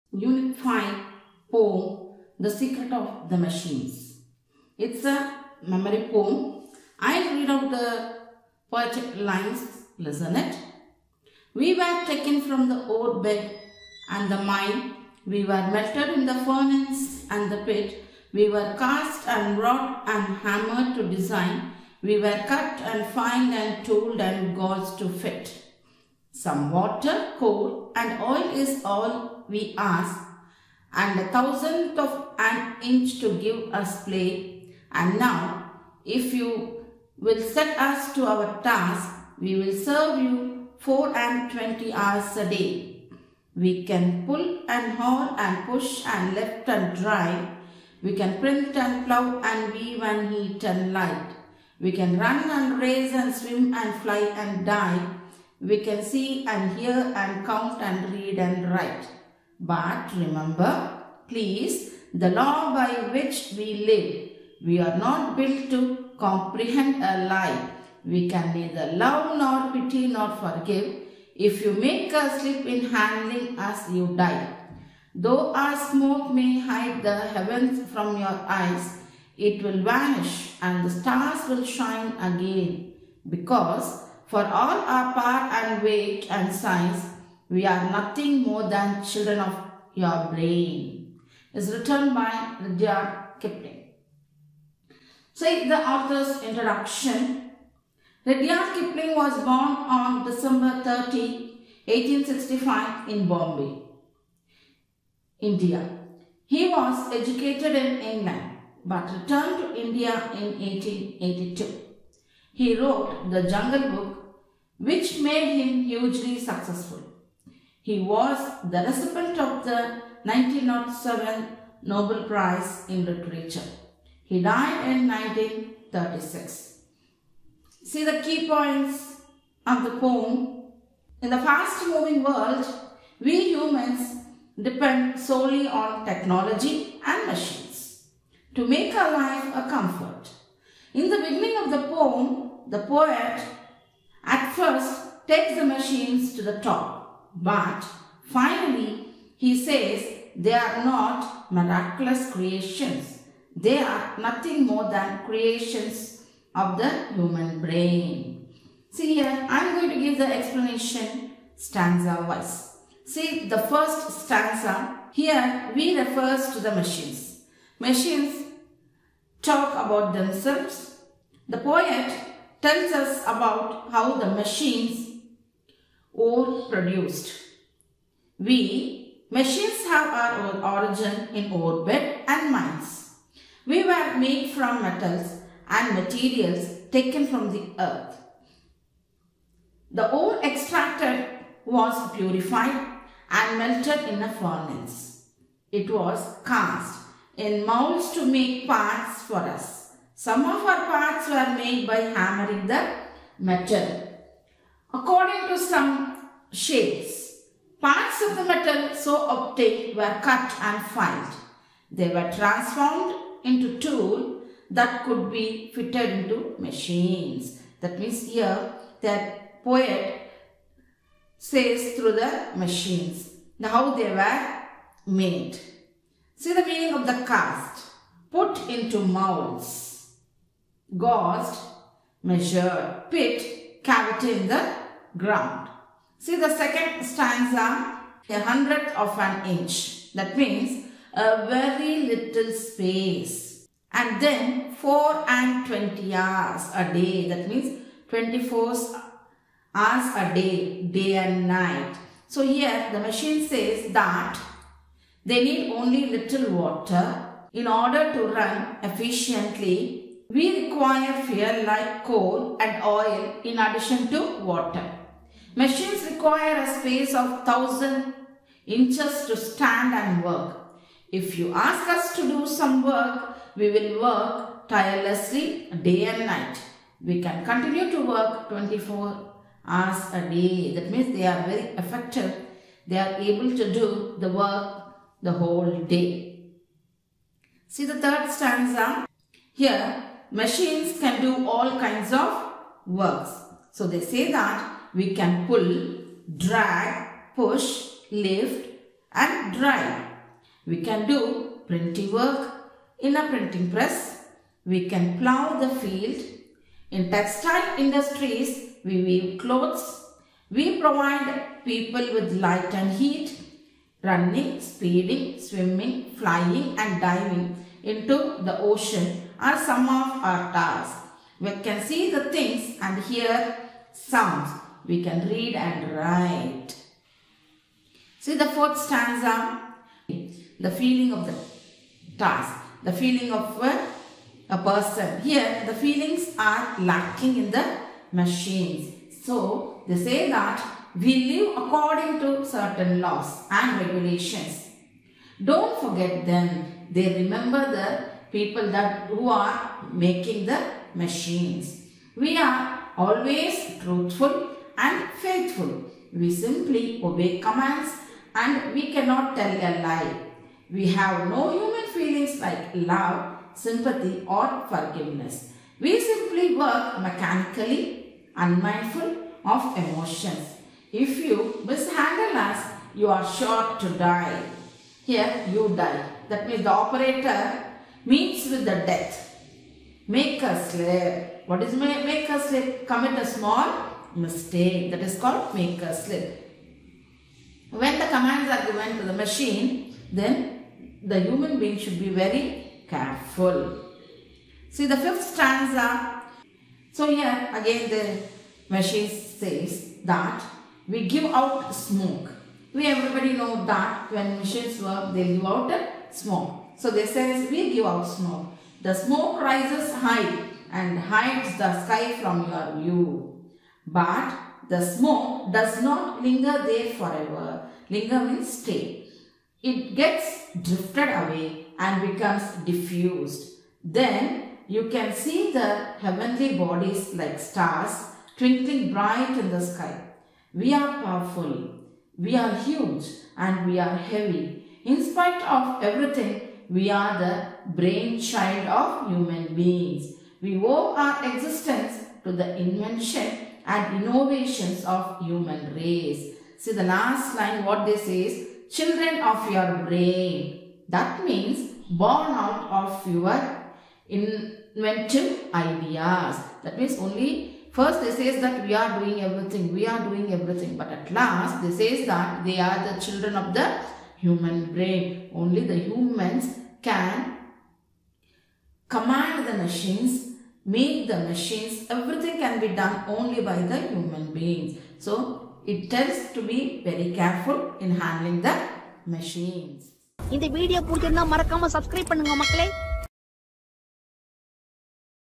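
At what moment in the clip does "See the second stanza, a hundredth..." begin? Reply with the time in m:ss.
3:56.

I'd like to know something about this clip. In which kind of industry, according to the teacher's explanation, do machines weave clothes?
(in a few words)
textile industries.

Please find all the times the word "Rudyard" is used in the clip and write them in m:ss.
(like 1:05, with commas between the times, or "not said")
1:32, 1:38.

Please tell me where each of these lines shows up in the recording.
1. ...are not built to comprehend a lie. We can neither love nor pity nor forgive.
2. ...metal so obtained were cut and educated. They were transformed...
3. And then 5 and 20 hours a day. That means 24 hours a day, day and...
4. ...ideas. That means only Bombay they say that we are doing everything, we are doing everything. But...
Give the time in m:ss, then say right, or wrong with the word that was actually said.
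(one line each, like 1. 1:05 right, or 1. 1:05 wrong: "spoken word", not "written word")
1. 1:04 right
2. 3:28 wrong: "filed", not "educated"
3. 4:03 wrong: "4", not "5"
4. 7:35 wrong: "First", not "Bombay".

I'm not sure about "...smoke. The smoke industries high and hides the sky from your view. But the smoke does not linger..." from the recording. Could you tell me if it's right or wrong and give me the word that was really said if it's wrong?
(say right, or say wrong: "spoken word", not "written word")
wrong: "rises", not "industries".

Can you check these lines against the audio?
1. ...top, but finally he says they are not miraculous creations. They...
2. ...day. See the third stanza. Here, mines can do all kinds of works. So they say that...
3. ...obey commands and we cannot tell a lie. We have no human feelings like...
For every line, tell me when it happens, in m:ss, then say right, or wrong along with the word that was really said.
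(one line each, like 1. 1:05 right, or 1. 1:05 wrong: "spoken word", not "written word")
1. 2:26 right
2. 4:45 wrong: "machines", not "mines"
3. 5:57 right.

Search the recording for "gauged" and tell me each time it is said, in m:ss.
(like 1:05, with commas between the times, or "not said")
0:24, 3:50.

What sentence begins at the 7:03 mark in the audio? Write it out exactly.
Then you can see the heavenly bodies like stars twinkling bright in the sky.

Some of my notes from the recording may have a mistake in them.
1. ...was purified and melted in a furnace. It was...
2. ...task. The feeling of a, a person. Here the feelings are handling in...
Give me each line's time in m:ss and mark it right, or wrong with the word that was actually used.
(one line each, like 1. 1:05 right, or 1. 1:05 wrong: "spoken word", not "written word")
1. 3:11 right
2. 5:32 wrong: "lacking", not "handling".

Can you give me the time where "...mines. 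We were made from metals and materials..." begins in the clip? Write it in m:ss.
3:02.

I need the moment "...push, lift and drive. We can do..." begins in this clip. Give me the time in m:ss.
4:57.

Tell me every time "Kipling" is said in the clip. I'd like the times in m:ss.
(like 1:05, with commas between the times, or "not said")
1:33, 1:38.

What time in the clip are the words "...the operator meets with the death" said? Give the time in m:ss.
6:16.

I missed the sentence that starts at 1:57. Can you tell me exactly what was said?
He was the recipient of the 1907 Nobel Prize in Literature.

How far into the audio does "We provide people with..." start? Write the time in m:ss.
5:10.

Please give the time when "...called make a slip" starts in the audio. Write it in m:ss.
6:25.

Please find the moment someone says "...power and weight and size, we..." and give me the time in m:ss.
1:25.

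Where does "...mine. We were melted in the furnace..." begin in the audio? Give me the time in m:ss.
0:14.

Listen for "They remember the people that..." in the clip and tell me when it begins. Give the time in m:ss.
5:46.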